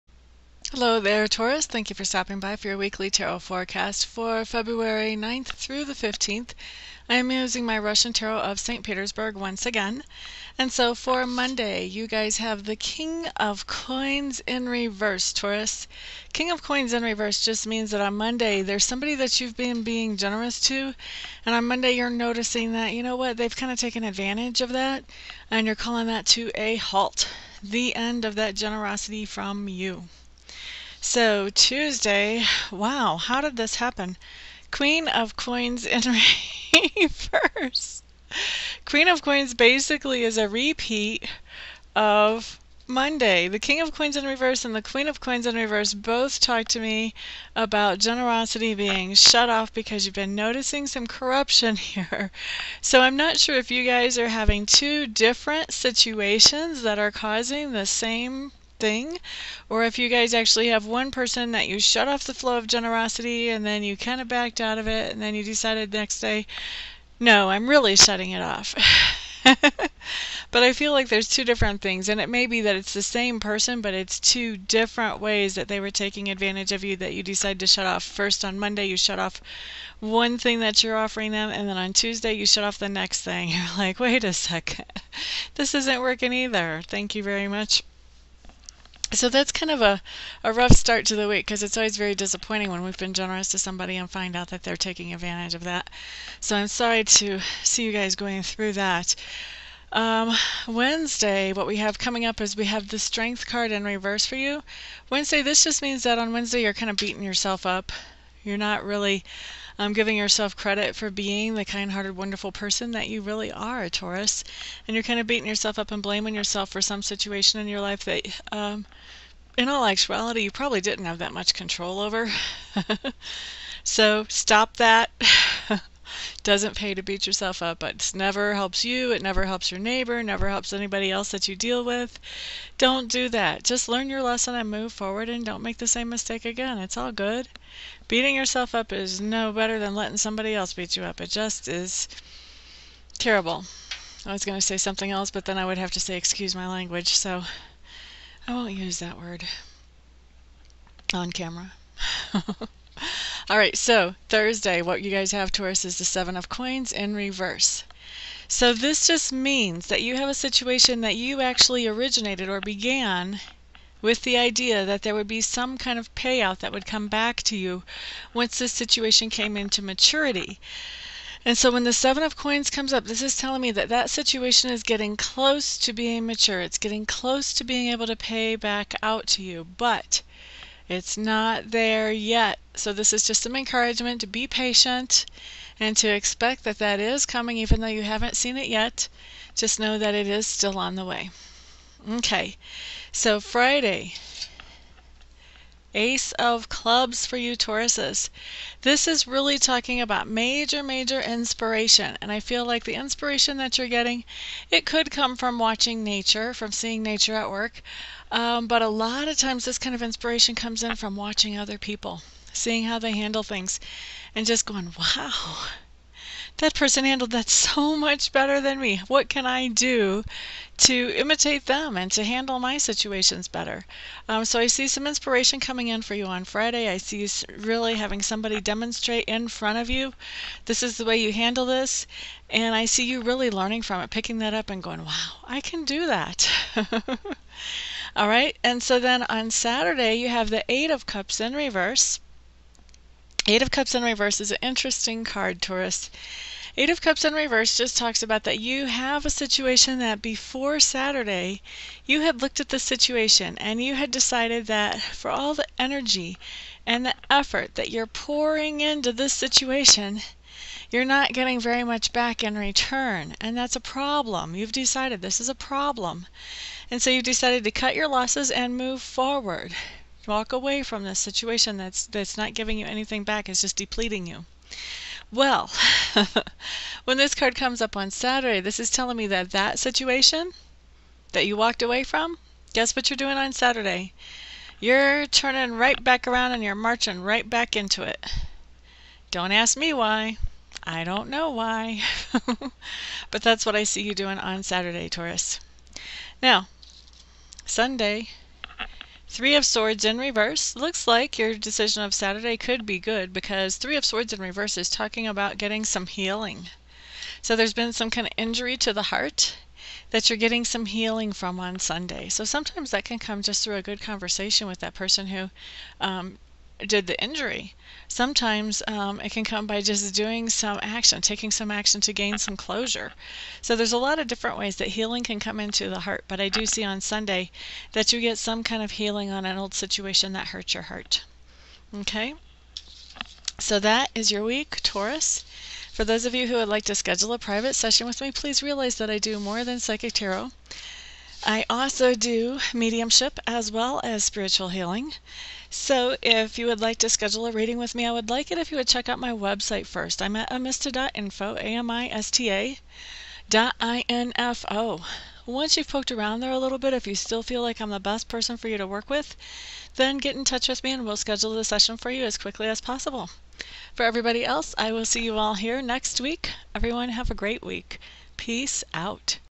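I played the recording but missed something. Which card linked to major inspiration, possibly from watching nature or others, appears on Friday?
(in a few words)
Ace of Clubs.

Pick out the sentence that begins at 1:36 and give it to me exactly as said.
So I'm sorry to see you guys going through that.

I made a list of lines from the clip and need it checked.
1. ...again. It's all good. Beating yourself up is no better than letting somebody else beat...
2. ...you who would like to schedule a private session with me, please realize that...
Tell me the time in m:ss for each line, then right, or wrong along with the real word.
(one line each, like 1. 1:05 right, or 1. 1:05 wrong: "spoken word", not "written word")
1. 2:16 right
2. 5:36 right.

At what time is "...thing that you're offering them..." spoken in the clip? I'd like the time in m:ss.
1:20.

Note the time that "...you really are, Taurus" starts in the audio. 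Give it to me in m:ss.
1:53.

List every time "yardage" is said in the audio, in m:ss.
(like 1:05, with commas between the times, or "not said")
not said.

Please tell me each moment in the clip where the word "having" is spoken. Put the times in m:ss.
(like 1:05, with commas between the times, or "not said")
0:54, 3:47.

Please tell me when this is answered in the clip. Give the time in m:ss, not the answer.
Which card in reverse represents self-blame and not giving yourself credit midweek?
1:42.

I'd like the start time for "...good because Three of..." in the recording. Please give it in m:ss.
5:02.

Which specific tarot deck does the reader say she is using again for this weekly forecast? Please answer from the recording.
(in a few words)
Russian tarot of St. Petersburg.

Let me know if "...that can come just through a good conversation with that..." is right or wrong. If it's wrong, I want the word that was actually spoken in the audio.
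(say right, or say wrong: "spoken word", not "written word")
right.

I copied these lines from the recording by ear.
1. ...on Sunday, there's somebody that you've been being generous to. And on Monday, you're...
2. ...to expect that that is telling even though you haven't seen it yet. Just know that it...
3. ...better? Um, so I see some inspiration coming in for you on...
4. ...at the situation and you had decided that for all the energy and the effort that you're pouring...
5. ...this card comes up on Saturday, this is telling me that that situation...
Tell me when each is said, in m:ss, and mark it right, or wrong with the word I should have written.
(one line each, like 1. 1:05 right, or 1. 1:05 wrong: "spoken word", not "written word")
1. 0:17 wrong: "Monday", not "Sunday"
2. 3:05 wrong: "coming", not "telling"
3. 3:43 right
4. 4:12 right
5. 4:37 right.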